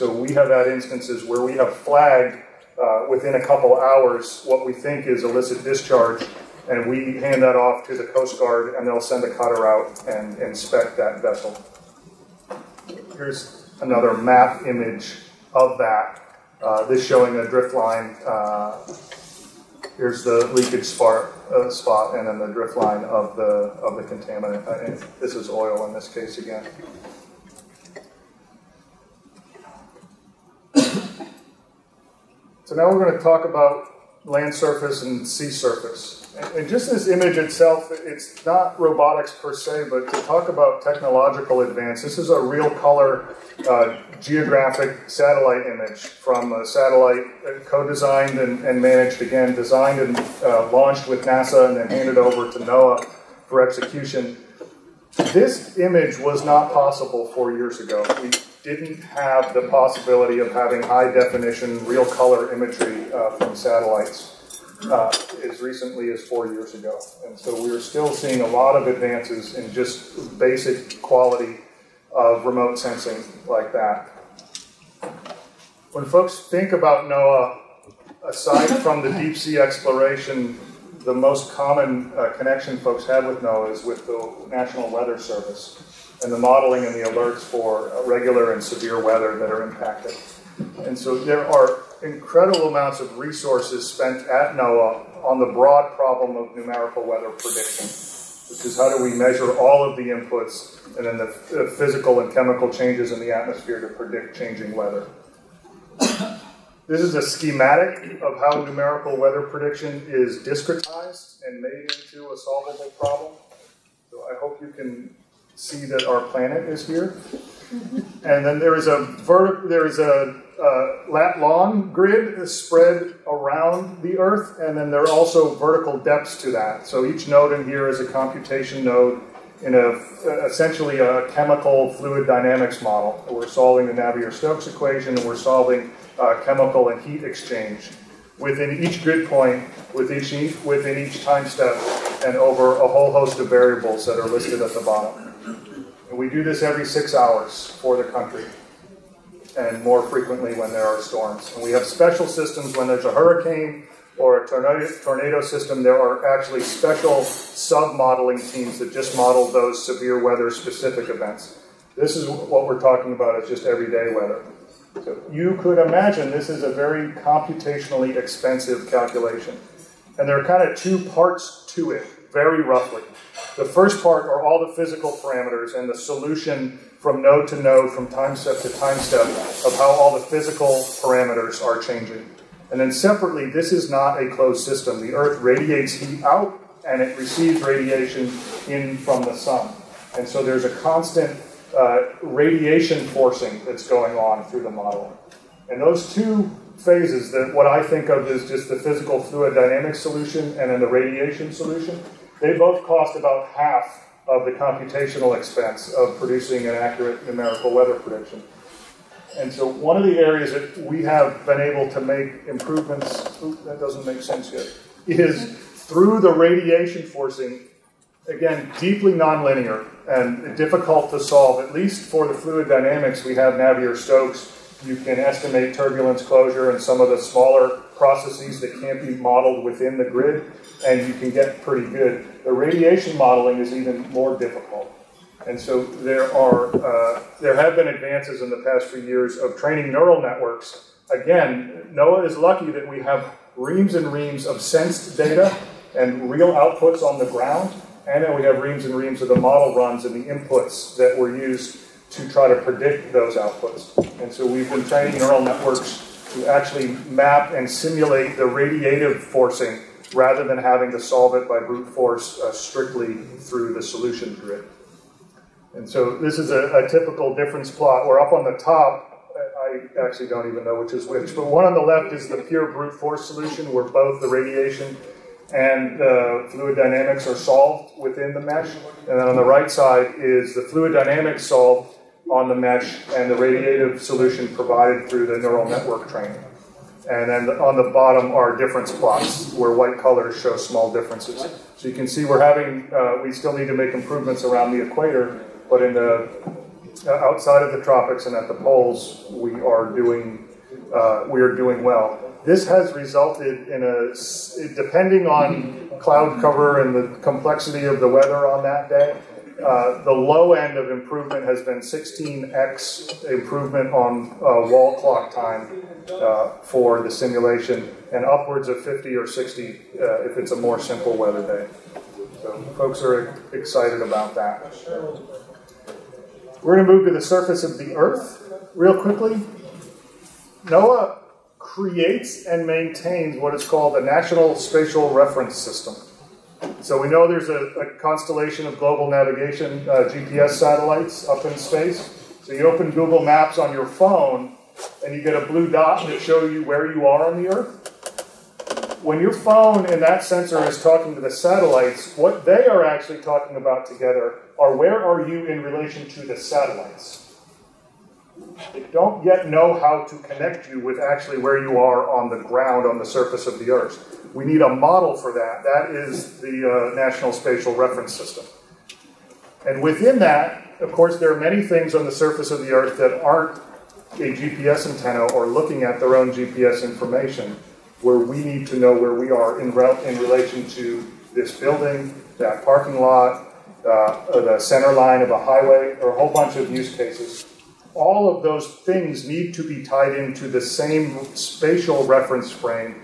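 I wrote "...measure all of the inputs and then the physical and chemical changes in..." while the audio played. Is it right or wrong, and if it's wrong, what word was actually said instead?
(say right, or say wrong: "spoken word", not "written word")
right.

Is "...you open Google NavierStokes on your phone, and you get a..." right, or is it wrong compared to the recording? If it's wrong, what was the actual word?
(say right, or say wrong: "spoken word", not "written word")
wrong: "Maps", not "NavierStokes".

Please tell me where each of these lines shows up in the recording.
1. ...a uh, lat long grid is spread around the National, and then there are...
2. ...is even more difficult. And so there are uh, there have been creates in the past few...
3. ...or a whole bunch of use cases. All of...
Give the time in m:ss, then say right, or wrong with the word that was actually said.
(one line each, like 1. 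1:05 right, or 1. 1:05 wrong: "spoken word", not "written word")
1. 1:59 wrong: "Earth", not "National"
2. 3:53 wrong: "advances", not "creates"
3. 6:26 right.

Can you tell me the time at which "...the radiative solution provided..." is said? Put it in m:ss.
4:43.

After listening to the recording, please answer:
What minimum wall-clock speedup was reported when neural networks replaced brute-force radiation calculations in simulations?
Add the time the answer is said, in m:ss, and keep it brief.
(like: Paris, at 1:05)
16x, at 5:11.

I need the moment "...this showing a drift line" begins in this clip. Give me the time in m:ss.
0:16.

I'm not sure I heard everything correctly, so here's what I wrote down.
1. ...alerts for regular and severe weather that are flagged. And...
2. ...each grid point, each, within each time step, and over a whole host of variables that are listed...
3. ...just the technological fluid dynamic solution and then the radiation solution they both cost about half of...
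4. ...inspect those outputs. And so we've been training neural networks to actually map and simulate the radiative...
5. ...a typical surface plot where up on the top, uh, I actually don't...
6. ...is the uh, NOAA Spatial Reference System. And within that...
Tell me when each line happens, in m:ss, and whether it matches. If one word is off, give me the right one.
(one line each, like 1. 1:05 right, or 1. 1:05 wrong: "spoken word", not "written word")
1. 1:27 wrong: "impacted", not "flagged"
2. 2:18 right
3. 3:18 wrong: "physical", not "technological"
4. 4:12 wrong: "predict", not "inspect"
5. 4:26 wrong: "difference", not "surface"
6. 6:05 wrong: "National", not "NOAA".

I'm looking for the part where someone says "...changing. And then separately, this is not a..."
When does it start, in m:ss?
3:01.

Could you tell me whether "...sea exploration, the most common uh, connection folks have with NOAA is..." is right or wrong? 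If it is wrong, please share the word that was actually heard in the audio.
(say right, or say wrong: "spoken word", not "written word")
right.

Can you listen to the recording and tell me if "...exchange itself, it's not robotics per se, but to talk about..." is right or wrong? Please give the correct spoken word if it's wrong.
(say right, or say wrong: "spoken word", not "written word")
wrong: "image", not "exchange".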